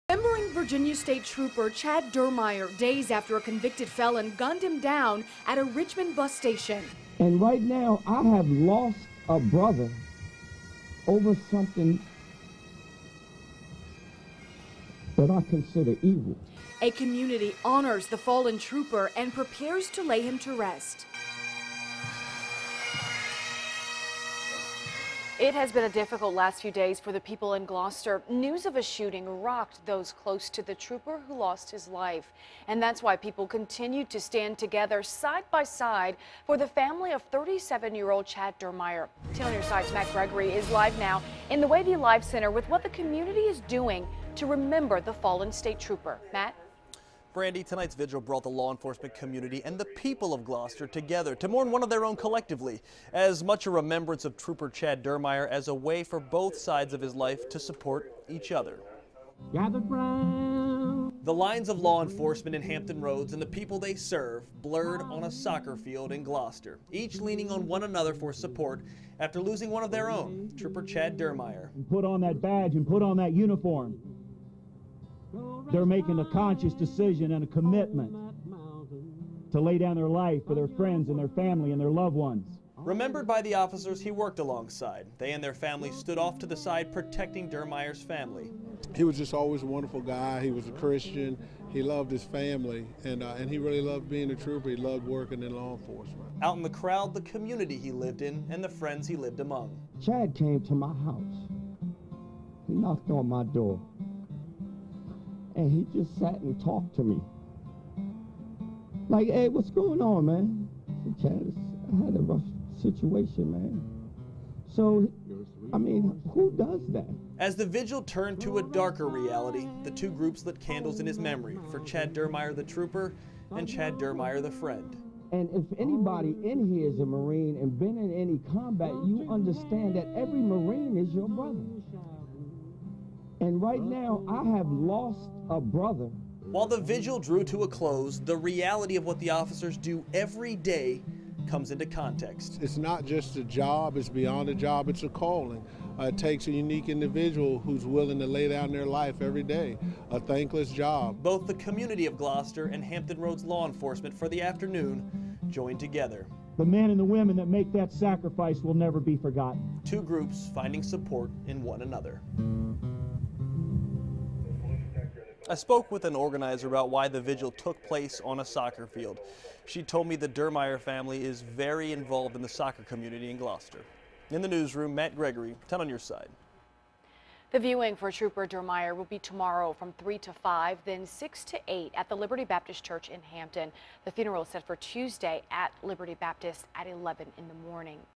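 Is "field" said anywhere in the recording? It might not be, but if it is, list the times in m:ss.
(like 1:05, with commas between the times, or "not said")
1:05, 2:48.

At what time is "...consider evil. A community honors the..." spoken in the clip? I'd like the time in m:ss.
0:15.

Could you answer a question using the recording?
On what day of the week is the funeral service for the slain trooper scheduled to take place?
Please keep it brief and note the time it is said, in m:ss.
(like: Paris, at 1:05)
Tuesday, at 3:04.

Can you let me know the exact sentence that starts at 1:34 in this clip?
He loved working in law enforcement.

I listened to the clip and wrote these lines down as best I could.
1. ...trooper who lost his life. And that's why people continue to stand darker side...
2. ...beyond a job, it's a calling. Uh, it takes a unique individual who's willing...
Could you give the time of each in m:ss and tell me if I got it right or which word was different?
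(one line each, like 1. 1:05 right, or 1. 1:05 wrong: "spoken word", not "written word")
1. 0:30 wrong: "together", not "darker"
2. 2:24 right.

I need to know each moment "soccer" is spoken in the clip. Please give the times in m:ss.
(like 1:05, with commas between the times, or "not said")
1:05, 2:48, 2:52.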